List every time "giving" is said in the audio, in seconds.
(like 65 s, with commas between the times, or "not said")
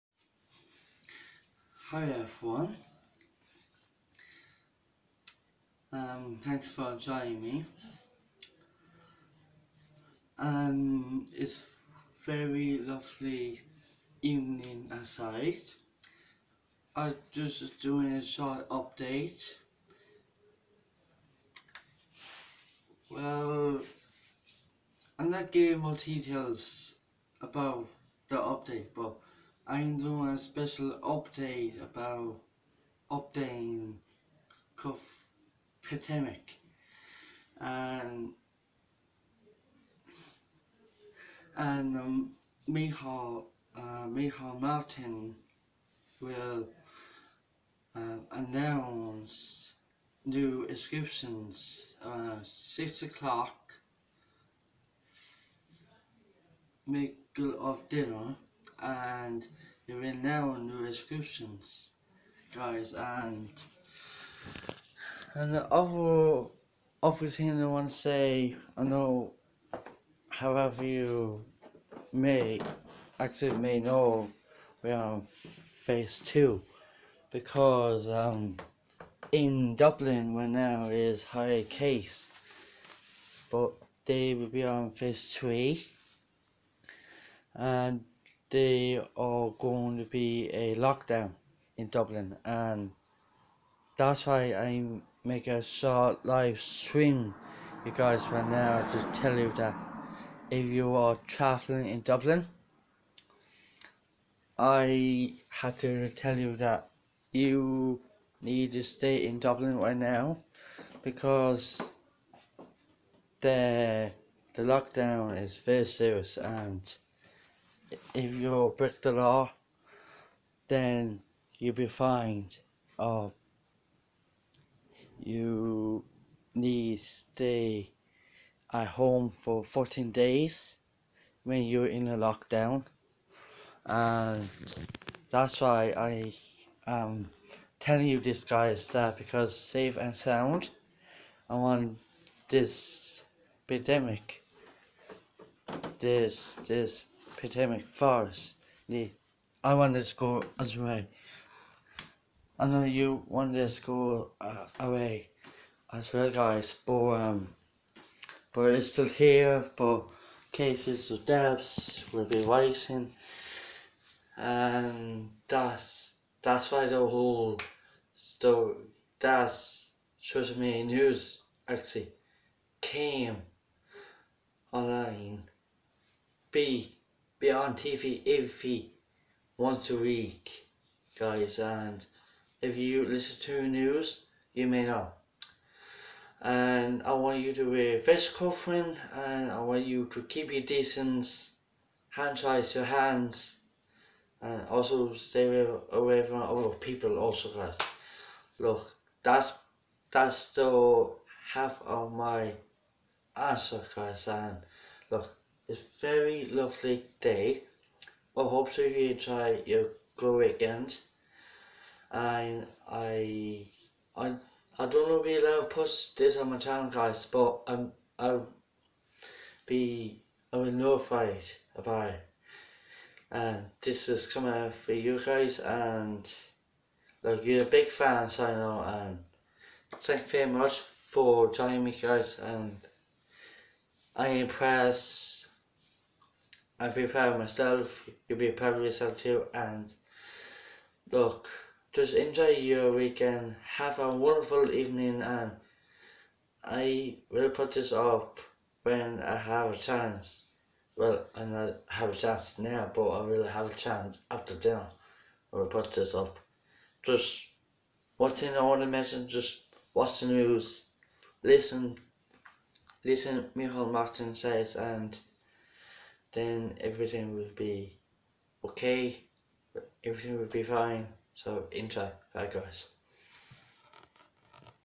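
25 s.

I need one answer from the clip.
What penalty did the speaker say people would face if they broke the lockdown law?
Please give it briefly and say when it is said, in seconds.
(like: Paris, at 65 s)
Fined, at 121 s.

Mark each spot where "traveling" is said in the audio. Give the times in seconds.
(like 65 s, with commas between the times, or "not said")
101 s.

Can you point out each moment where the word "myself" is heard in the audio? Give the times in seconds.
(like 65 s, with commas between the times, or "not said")
237 s.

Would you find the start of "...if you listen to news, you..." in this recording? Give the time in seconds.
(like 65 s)
182 s.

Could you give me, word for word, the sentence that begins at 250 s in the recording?
Well, I not have a chance now, but I will have a chance after dinner.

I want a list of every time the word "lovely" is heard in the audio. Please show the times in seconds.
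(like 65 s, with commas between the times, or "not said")
12 s, 206 s.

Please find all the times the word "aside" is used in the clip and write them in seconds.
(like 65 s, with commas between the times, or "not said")
14 s.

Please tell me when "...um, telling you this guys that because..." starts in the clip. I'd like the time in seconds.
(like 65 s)
137 s.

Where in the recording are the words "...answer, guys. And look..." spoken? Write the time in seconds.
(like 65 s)
203 s.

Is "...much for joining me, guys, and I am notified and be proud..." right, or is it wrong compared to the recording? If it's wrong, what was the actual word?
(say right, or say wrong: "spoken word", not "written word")
wrong: "impressed", not "notified".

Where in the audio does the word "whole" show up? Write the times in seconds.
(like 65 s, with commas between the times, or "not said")
167 s.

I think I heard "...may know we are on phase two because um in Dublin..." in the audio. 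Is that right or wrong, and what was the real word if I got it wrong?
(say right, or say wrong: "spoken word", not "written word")
right.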